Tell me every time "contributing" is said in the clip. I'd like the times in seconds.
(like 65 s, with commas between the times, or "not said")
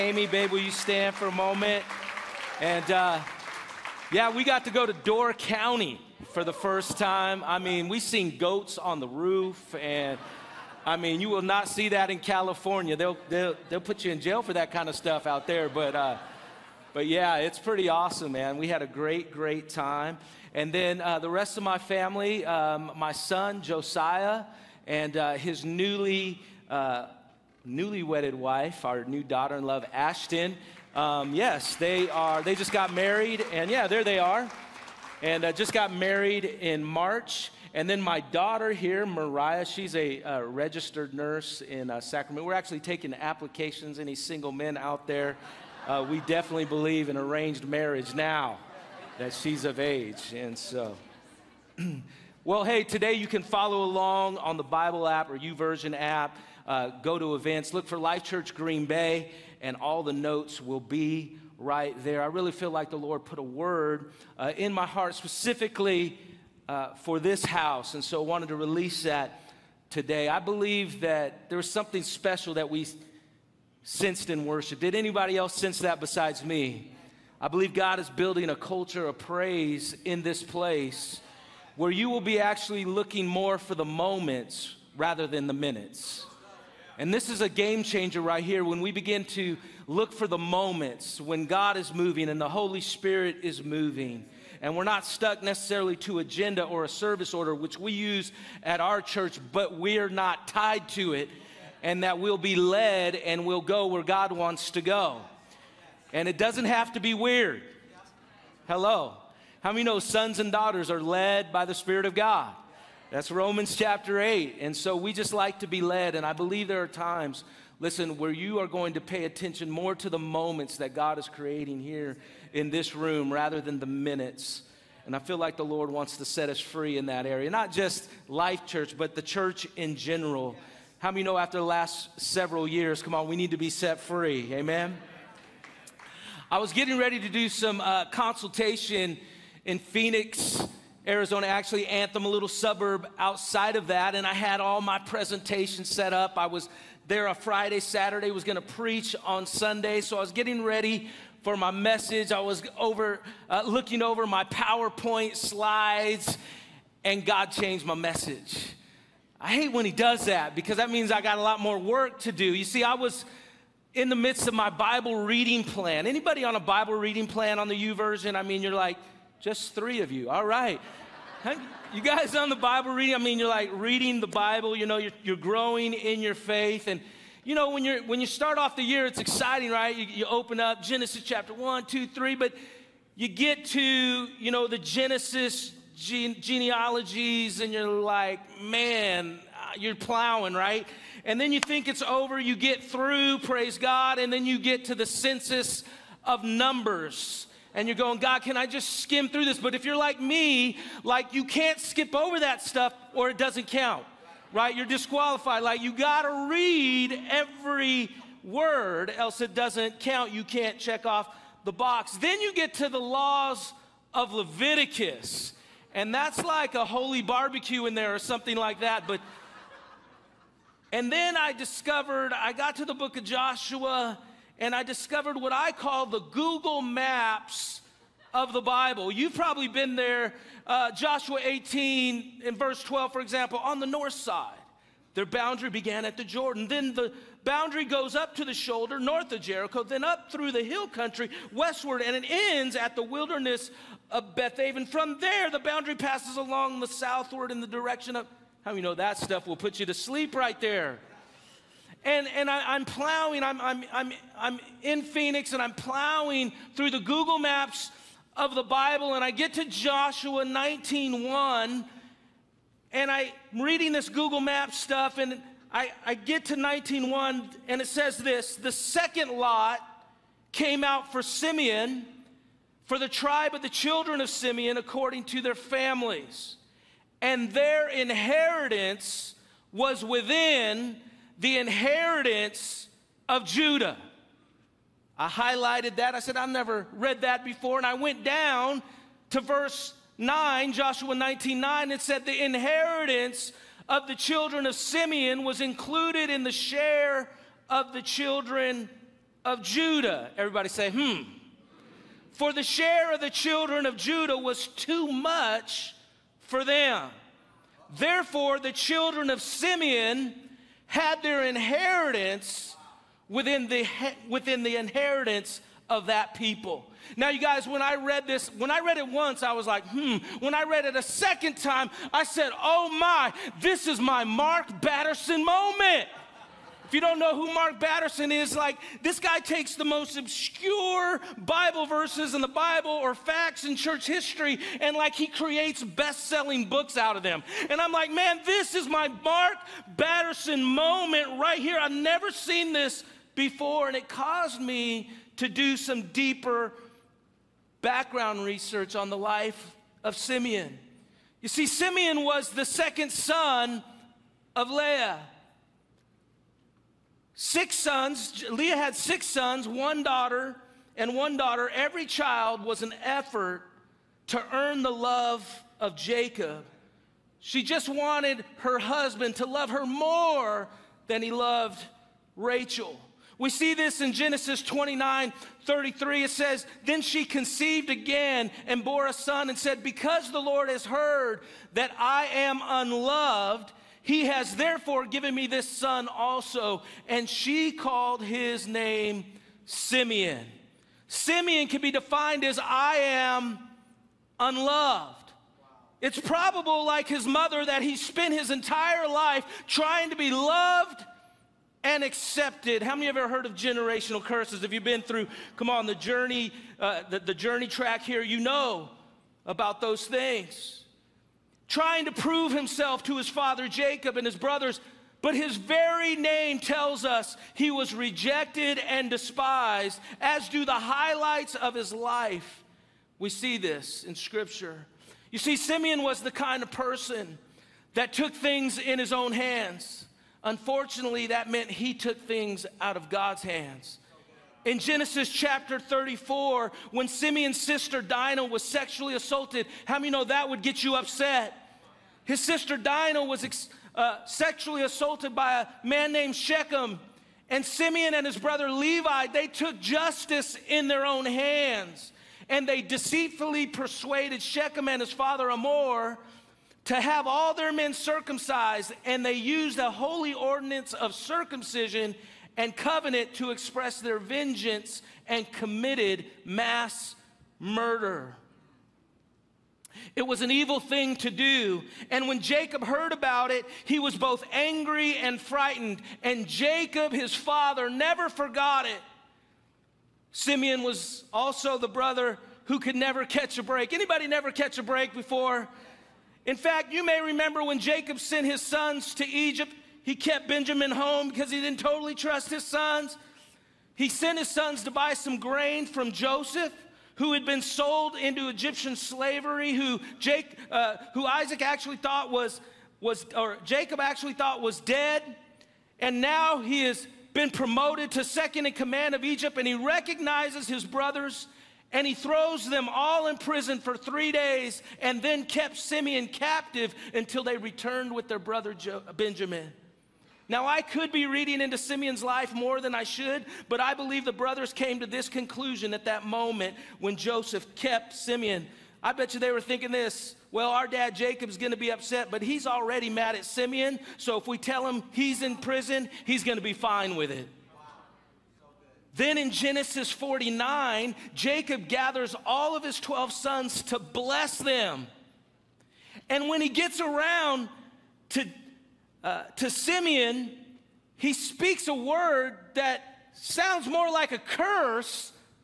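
not said.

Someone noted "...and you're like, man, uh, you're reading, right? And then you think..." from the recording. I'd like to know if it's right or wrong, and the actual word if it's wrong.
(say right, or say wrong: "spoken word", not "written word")
wrong: "plowing", not "reading".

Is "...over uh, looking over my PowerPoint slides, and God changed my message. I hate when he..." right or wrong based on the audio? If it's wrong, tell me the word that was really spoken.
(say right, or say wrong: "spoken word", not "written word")
right.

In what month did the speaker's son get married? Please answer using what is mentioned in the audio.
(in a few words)
March.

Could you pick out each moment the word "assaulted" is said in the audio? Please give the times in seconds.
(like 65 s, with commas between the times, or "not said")
439 s, 444 s.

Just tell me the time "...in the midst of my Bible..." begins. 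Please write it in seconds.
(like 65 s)
163 s.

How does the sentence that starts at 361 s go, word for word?
Every child was an effort to earn the love of Jacob.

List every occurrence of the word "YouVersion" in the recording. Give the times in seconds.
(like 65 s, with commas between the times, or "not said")
55 s, 167 s.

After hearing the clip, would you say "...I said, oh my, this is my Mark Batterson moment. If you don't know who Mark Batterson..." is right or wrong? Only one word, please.
right.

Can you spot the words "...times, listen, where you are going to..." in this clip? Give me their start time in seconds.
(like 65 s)
116 s.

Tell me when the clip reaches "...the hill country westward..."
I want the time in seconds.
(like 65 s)
240 s.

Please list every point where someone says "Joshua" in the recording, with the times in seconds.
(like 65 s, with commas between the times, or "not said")
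223 s, 230 s, 259 s, 290 s.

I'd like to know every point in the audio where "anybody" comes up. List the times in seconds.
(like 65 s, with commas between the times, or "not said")
74 s, 166 s, 483 s.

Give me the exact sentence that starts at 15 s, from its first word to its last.
But, uh, but yeah, it's pretty awesome, man.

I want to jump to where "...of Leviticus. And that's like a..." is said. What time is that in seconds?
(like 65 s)
214 s.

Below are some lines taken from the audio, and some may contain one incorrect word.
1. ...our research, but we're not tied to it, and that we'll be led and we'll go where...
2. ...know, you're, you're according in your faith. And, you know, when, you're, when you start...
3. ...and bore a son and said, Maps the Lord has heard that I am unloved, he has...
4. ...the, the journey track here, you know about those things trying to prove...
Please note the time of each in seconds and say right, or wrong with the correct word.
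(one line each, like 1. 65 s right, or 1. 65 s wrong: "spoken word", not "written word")
1. 98 s wrong: "church", not "research"
2. 174 s wrong: "growing", not "according"
3. 378 s wrong: "Because", not "Maps"
4. 407 s right.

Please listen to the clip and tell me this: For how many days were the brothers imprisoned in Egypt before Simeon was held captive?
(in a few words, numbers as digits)
3.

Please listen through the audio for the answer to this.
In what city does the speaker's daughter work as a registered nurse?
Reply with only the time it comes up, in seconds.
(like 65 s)
42 s.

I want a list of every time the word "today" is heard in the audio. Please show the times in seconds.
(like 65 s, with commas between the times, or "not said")
52 s, 69 s.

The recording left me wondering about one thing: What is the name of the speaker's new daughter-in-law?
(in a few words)
Ashton.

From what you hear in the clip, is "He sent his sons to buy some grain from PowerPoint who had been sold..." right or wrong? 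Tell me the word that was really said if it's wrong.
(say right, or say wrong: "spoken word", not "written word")
wrong: "Joseph", not "PowerPoint".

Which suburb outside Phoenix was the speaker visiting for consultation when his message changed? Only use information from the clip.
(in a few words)
Anthem.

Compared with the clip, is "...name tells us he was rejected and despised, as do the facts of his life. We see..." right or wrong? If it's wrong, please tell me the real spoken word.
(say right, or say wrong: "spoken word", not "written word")
wrong: "highlights", not "facts".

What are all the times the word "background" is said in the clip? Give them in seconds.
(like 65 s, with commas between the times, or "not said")
347 s.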